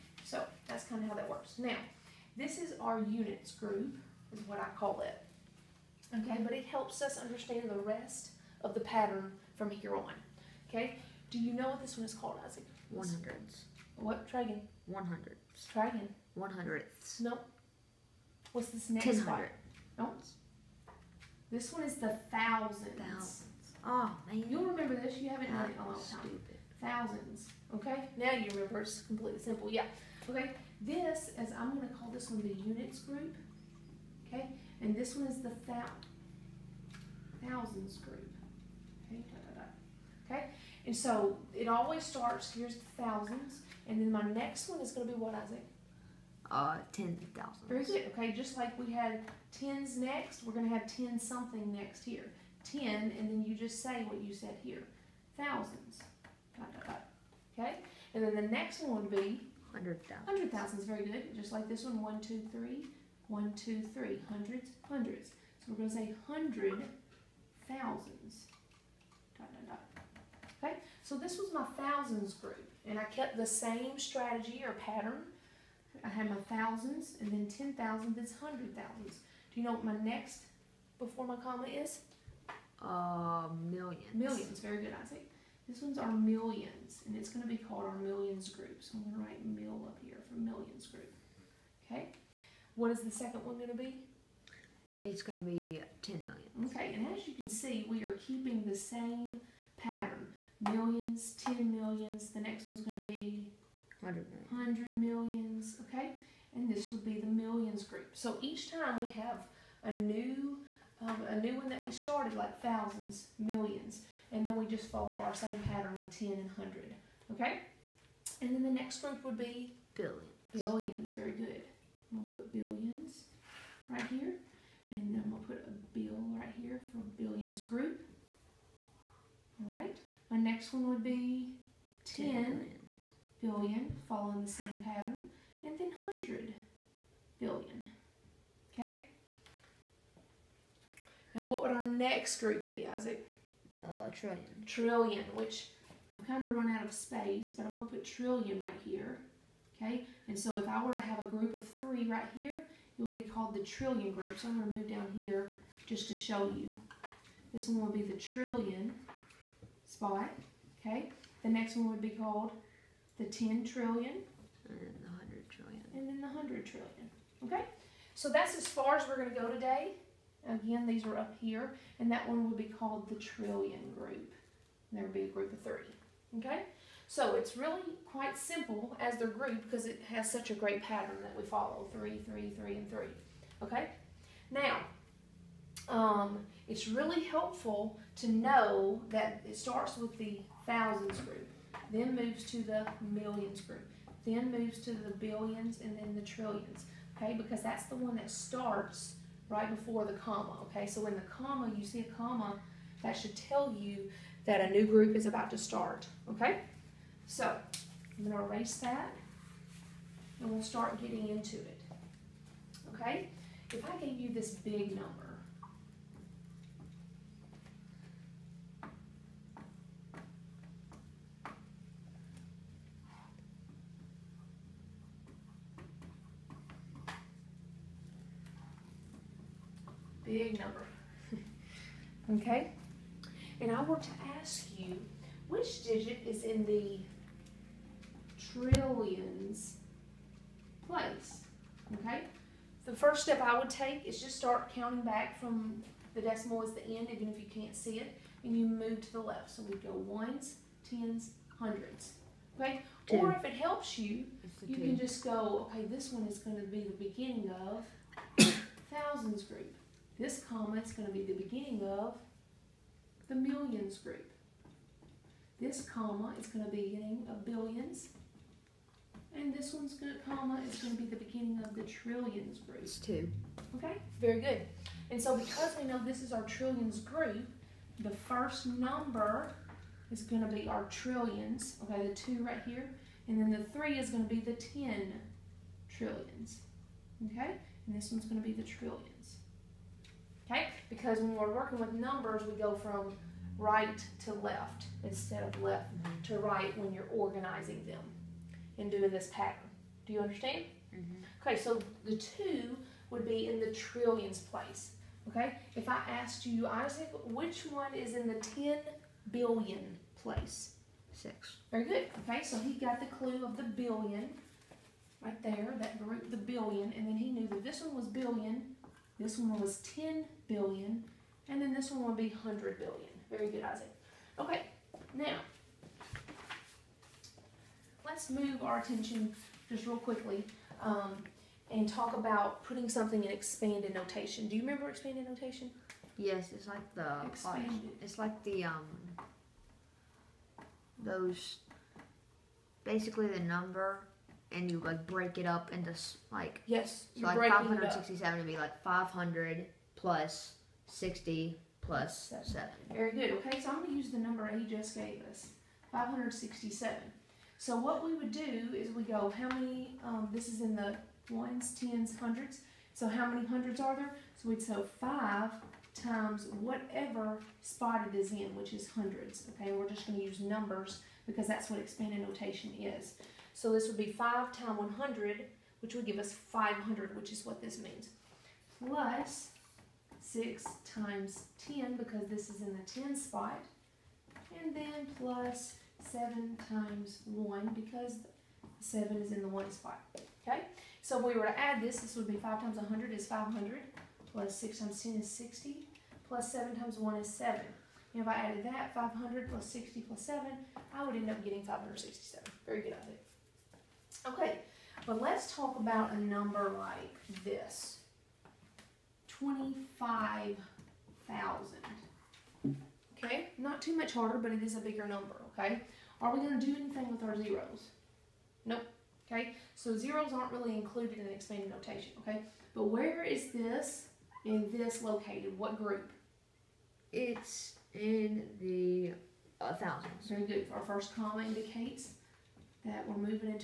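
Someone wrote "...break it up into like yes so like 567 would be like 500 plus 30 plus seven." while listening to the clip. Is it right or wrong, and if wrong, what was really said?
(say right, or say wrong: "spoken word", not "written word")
wrong: "60", not "30".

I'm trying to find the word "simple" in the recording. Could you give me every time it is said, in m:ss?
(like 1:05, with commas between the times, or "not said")
0:29, 2:58.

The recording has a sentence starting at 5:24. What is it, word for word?
Okay, now, let's move our attention just real quickly um, and talk about putting something in expanded notation.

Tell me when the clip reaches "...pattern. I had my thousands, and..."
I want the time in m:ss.
1:14.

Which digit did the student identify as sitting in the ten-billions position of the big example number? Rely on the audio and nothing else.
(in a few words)
6.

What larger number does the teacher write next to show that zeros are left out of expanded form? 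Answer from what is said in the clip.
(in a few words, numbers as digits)
25,000.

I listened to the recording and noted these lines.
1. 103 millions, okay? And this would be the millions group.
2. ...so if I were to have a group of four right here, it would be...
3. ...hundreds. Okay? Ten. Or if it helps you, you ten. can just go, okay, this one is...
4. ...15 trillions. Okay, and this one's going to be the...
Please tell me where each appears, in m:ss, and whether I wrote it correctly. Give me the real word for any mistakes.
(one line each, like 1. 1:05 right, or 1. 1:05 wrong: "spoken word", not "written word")
1. 1:44 wrong: "100", not "103"
2. 2:30 wrong: "three", not "four"
3. 4:11 right
4. 4:44 wrong: "10", not "15".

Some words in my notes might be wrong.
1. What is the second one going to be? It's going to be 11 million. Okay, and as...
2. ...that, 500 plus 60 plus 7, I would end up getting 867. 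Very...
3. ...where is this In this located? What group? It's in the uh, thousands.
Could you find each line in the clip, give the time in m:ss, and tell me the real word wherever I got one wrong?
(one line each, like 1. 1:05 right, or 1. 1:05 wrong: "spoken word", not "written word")
1. 1:32 wrong: "10", not "11"
2. 6:38 wrong: "567", not "867"
3. 7:02 right.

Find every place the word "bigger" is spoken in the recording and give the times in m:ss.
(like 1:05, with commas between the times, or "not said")
6:54.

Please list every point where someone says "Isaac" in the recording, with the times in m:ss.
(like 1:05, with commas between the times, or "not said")
0:12, 0:45, 1:25, 2:22, 5:06, 5:23.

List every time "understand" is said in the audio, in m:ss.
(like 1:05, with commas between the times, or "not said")
0:07, 5:00.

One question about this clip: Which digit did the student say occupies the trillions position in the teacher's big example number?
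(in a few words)
2.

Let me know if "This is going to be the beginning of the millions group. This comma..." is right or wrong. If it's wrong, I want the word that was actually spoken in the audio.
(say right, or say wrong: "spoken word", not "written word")
right.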